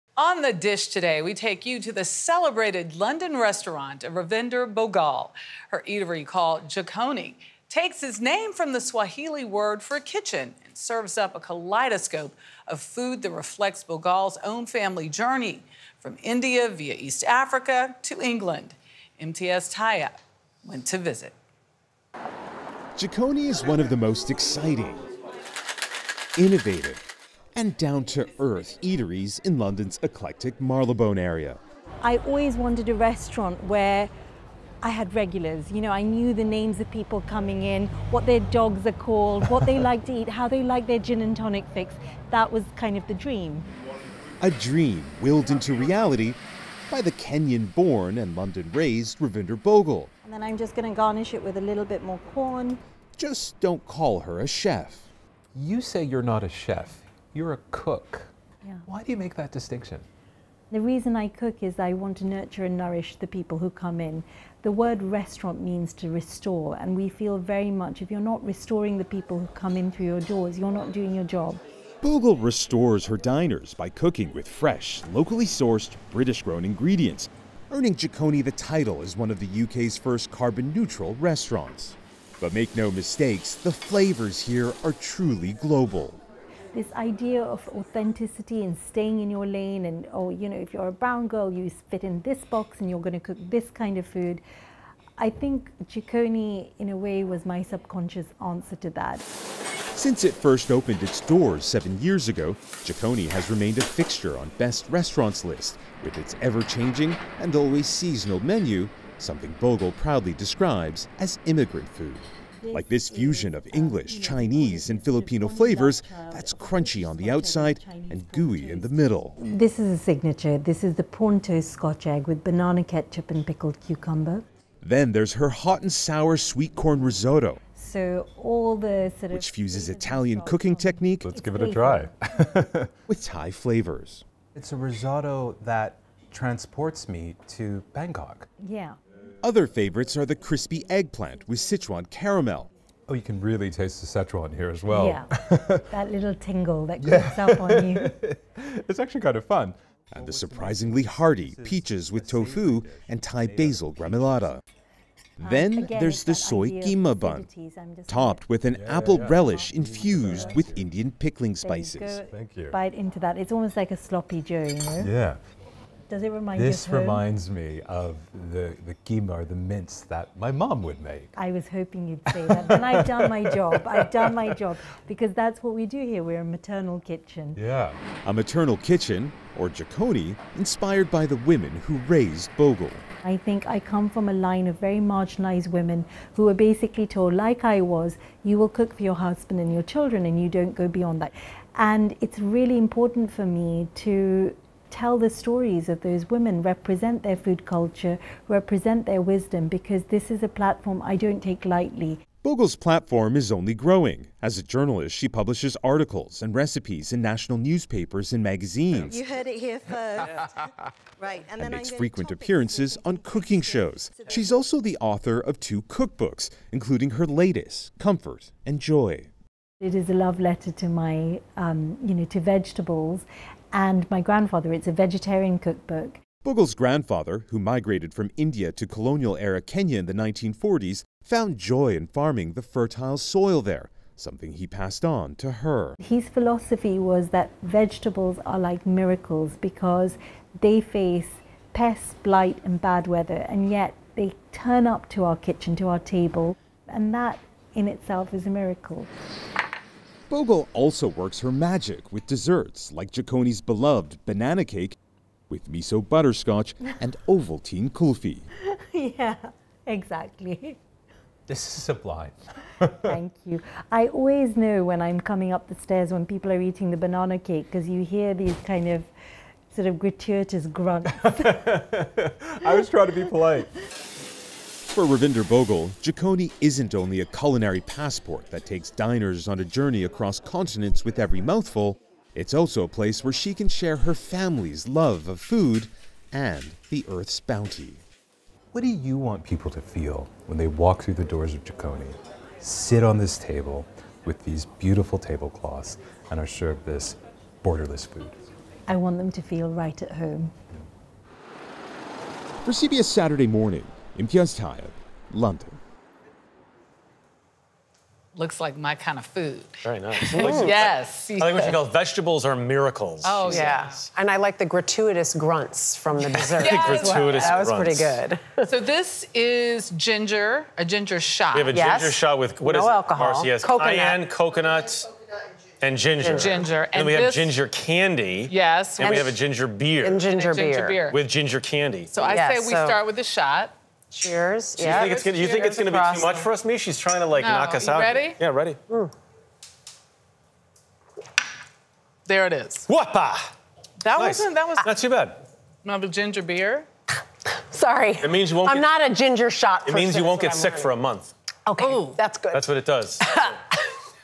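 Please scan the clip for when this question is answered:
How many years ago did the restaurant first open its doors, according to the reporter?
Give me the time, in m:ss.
1:41.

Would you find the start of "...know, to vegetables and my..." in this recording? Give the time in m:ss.
3:42.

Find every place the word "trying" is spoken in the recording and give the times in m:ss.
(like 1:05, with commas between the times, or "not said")
4:32, 5:36.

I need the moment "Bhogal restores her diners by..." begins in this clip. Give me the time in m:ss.
1:12.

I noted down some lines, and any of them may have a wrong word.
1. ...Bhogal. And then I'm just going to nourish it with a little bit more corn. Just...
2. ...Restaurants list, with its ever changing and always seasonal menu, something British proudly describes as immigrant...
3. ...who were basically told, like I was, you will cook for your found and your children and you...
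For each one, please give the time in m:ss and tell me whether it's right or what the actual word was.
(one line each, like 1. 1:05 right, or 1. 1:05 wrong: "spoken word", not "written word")
1. 0:49 wrong: "garnish", not "nourish"
2. 1:44 wrong: "Bhogal", not "British"
3. 3:06 wrong: "husband", not "found".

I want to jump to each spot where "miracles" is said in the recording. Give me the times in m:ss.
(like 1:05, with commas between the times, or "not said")
3:58, 4:08, 5:12.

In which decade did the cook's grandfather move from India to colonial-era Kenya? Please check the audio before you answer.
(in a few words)
1940s.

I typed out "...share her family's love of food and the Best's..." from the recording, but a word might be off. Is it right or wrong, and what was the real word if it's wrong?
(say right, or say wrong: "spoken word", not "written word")
wrong: "Earth", not "Best".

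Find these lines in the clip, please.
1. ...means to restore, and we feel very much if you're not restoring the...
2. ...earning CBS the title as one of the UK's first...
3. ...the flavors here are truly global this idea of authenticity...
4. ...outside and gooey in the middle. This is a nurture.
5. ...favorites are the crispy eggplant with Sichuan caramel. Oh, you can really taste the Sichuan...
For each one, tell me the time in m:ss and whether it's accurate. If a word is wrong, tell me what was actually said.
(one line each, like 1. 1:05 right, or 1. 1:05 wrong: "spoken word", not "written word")
1. 1:05 right
2. 1:17 wrong: "Jikoni", not "CBS"
3. 1:23 right
4. 1:57 wrong: "signature", not "nurture"
5. 2:19 right.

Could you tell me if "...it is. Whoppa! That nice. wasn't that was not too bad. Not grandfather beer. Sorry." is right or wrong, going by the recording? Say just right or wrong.
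wrong.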